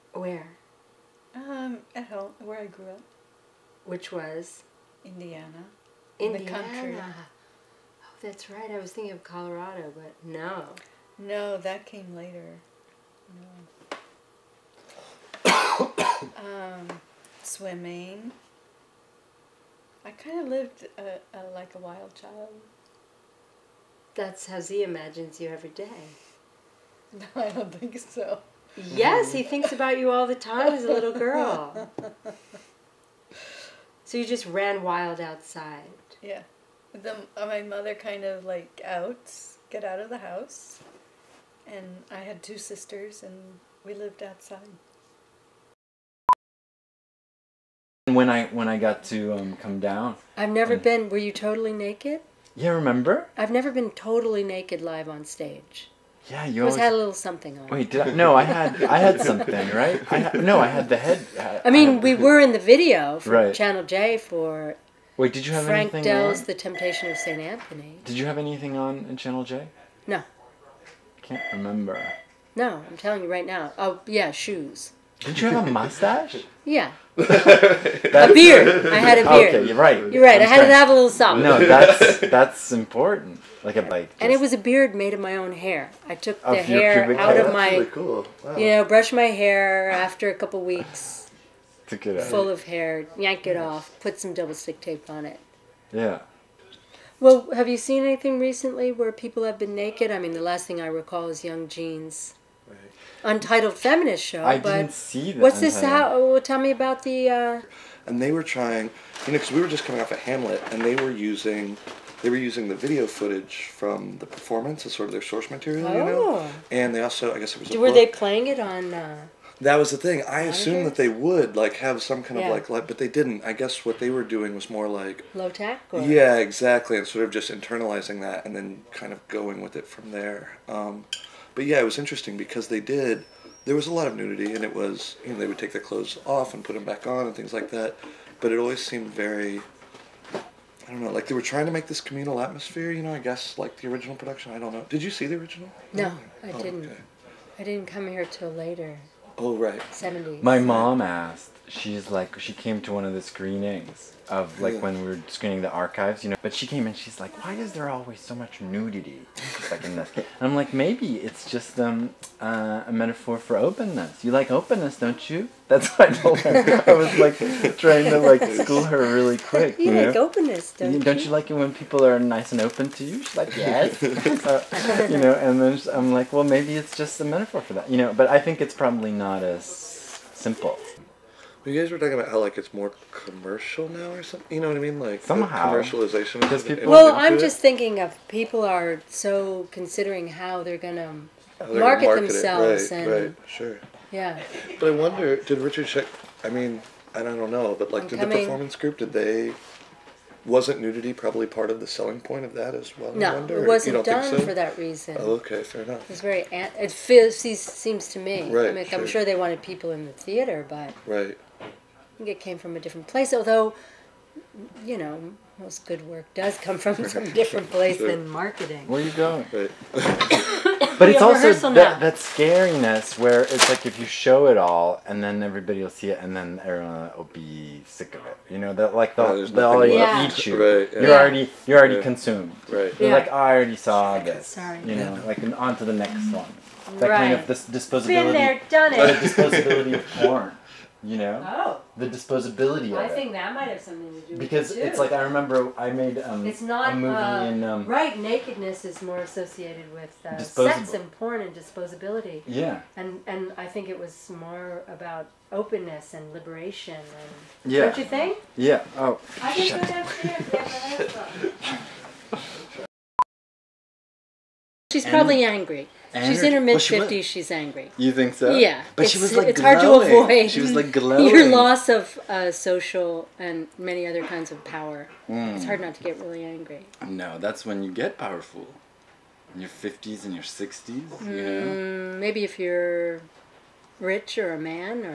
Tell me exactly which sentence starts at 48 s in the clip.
When I when I got to um, come down, I've never and...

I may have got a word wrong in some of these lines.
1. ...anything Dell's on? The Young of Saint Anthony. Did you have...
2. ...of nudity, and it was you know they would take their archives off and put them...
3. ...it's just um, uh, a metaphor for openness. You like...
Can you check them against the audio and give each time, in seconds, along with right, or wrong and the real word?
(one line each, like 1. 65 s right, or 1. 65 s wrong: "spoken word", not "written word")
1. 65 s wrong: "Temptation", not "Young"
2. 134 s wrong: "clothes", not "archives"
3. 161 s right.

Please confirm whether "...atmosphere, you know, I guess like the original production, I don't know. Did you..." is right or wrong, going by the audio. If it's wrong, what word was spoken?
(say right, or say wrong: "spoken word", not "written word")
right.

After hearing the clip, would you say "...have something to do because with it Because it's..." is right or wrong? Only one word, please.
right.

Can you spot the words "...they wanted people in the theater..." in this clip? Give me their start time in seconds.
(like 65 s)
209 s.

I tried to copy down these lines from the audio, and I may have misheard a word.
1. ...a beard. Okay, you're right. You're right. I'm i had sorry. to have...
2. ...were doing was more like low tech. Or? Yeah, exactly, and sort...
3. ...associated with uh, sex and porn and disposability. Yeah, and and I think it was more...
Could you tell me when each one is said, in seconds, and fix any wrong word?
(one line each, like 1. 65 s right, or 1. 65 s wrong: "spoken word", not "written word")
1. 79 s right
2. 124 s right
3. 249 s right.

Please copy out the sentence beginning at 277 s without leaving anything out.
No, that's when you get powerful.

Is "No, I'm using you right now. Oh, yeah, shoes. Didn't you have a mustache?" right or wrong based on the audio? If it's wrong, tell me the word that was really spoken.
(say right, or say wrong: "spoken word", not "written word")
wrong: "telling", not "using".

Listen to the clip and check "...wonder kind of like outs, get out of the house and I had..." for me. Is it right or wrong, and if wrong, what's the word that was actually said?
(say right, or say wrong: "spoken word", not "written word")
wrong: "mother", not "wonder".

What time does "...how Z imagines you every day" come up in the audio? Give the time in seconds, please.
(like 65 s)
24 s.